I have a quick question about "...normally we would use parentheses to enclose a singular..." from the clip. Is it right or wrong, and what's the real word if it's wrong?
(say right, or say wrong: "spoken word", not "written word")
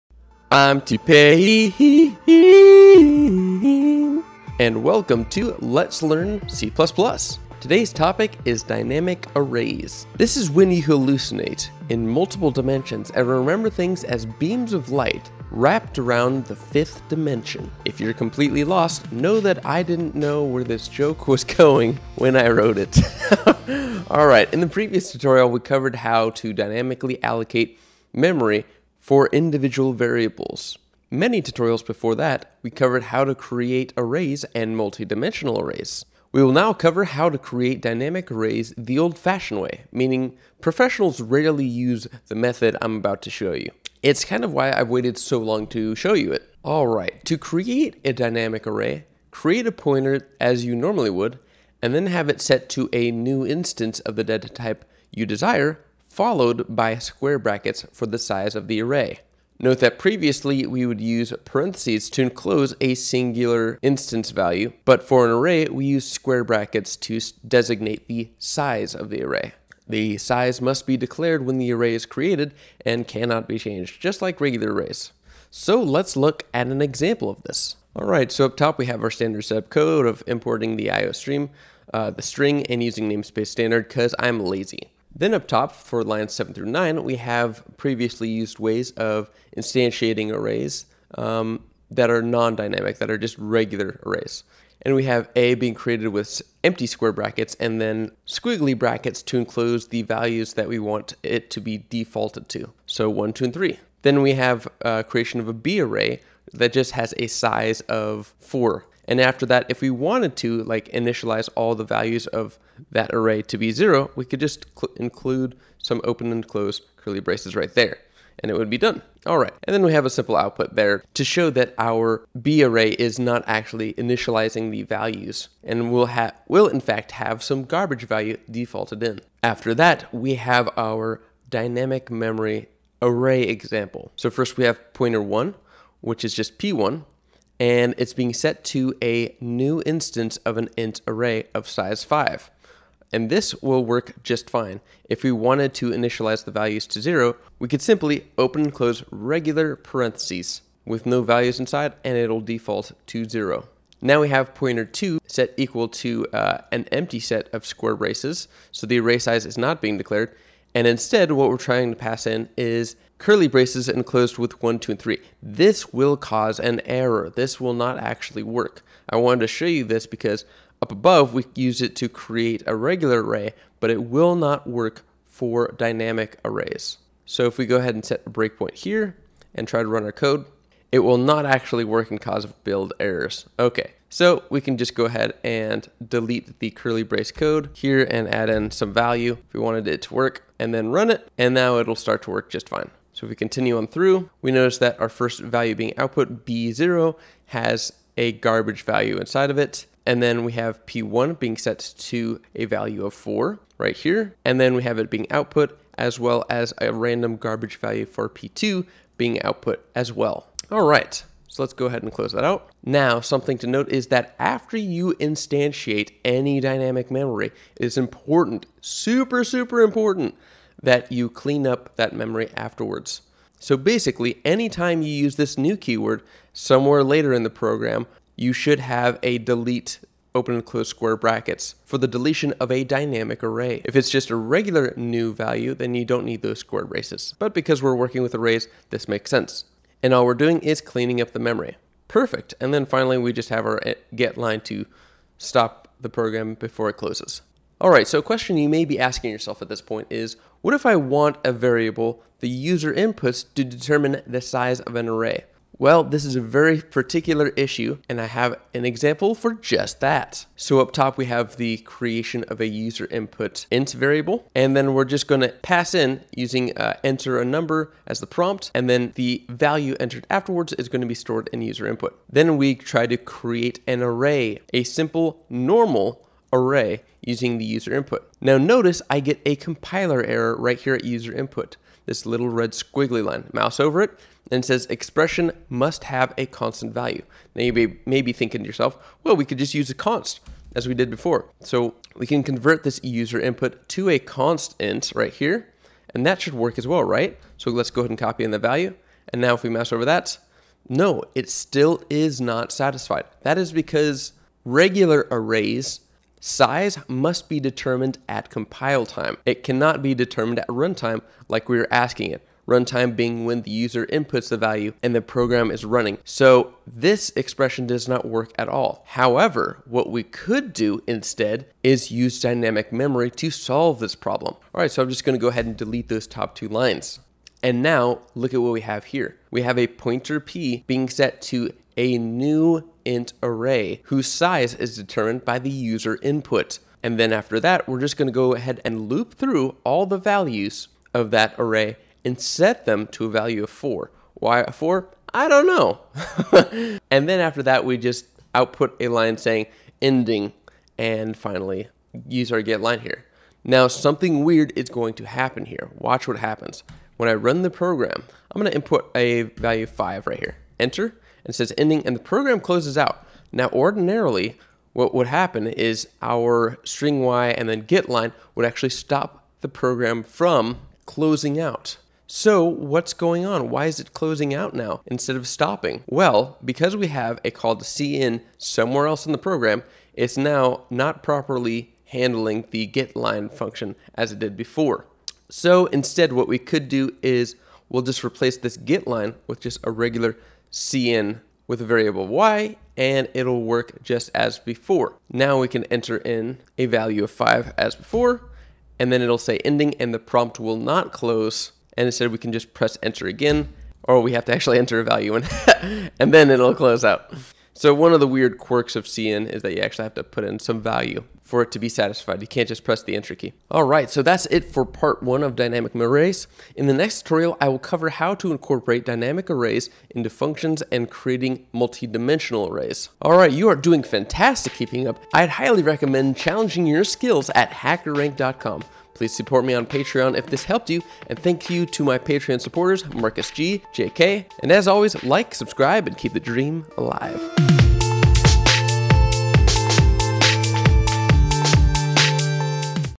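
wrong: "previously", not "normally".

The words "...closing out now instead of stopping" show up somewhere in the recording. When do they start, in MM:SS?
06:14.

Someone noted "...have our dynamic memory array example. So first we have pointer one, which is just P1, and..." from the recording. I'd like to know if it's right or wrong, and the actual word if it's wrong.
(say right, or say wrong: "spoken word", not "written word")
right.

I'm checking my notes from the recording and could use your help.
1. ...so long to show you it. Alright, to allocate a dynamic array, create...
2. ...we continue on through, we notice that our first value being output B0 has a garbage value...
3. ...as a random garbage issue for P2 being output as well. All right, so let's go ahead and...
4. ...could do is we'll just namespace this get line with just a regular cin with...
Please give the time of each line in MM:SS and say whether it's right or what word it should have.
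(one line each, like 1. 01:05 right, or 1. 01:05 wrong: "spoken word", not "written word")
1. 00:45 wrong: "create", not "allocate"
2. 03:13 right
3. 03:26 wrong: "value", not "issue"
4. 06:26 wrong: "replace", not "namespace".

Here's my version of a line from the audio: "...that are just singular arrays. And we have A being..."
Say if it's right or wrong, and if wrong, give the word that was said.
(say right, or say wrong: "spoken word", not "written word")
wrong: "regular", not "singular".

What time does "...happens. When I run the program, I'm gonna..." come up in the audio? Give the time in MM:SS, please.
05:56.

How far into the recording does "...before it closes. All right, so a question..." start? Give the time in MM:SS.
04:06.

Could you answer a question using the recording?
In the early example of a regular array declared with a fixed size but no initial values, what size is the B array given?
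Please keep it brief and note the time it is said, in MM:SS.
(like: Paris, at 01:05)
4, at 01:47.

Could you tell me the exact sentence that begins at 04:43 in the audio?
Mouse over it and it says expression must have a constant value.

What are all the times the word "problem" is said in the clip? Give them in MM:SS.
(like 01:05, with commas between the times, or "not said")
05:24.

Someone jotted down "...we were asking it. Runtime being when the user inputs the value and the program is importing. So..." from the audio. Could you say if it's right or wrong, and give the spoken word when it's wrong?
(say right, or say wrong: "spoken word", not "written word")
wrong: "running", not "importing".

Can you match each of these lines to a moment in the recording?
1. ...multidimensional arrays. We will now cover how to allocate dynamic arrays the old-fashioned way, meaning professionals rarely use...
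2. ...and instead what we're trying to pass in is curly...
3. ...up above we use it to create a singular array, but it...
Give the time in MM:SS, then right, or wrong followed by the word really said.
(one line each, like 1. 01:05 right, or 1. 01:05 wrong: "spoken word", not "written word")
1. 00:34 wrong: "create", not "allocate"
2. 02:40 right
3. 02:50 wrong: "regular", not "singular".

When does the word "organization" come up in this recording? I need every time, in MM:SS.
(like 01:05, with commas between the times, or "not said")
not said.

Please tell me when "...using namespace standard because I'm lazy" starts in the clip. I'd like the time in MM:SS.
01:22.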